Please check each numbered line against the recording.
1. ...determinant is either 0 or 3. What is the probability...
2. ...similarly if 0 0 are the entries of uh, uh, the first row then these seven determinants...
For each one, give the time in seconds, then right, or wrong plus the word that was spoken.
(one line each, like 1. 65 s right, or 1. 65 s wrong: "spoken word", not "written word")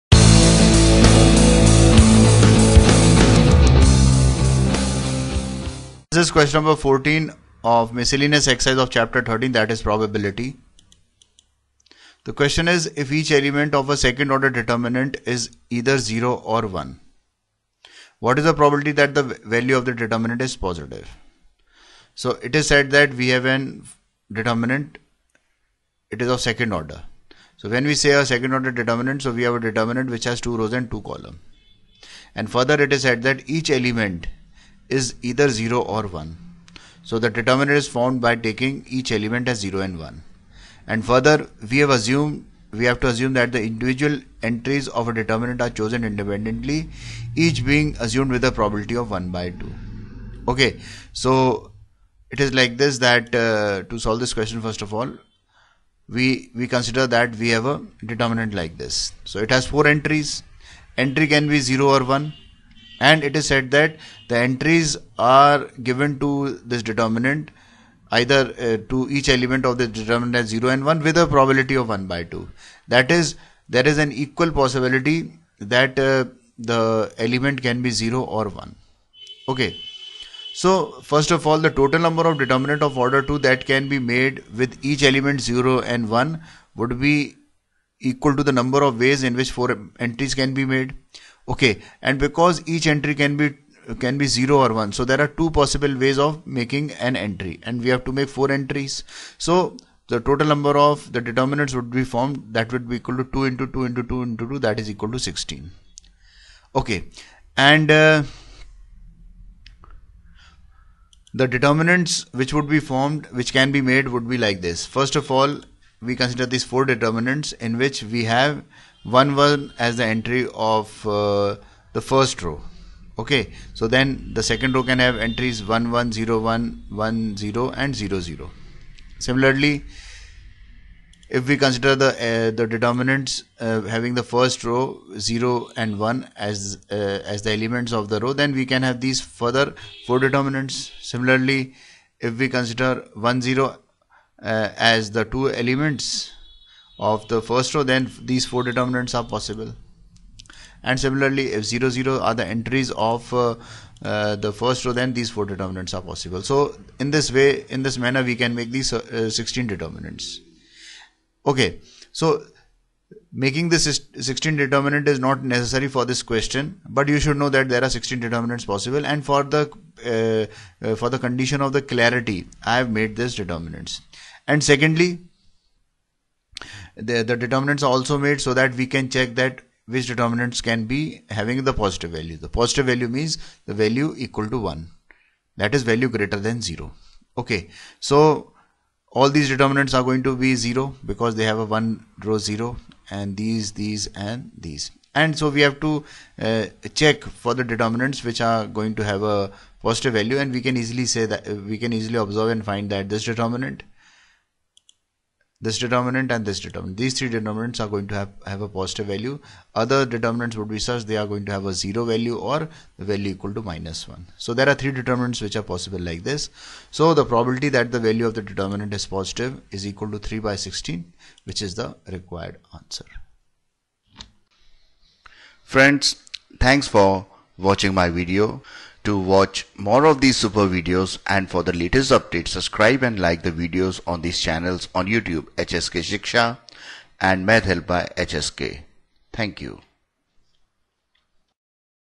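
1. 14 s wrong: "1", not "3"
2. 150 s wrong: "four", not "seven".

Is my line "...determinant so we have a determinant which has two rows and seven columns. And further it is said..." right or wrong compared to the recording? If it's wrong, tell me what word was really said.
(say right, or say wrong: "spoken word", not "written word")
wrong: "two", not "seven".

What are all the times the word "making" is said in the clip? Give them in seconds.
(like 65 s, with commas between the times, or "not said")
96 s, 163 s.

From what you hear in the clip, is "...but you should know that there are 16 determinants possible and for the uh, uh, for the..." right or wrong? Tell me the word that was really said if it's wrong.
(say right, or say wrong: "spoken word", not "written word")
right.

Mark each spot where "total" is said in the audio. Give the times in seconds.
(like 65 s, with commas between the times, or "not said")
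81 s, 100 s.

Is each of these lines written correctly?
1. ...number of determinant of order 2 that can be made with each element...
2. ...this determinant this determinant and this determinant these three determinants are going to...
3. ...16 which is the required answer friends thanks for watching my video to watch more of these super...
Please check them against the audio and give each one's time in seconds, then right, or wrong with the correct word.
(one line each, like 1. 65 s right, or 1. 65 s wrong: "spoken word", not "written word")
1. 82 s right
2. 203 s right
3. 220 s right.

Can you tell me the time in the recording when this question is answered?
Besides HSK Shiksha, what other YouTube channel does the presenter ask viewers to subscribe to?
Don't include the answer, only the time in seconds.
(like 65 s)
237 s.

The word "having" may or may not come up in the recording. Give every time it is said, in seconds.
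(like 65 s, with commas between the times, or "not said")
133 s, 181 s.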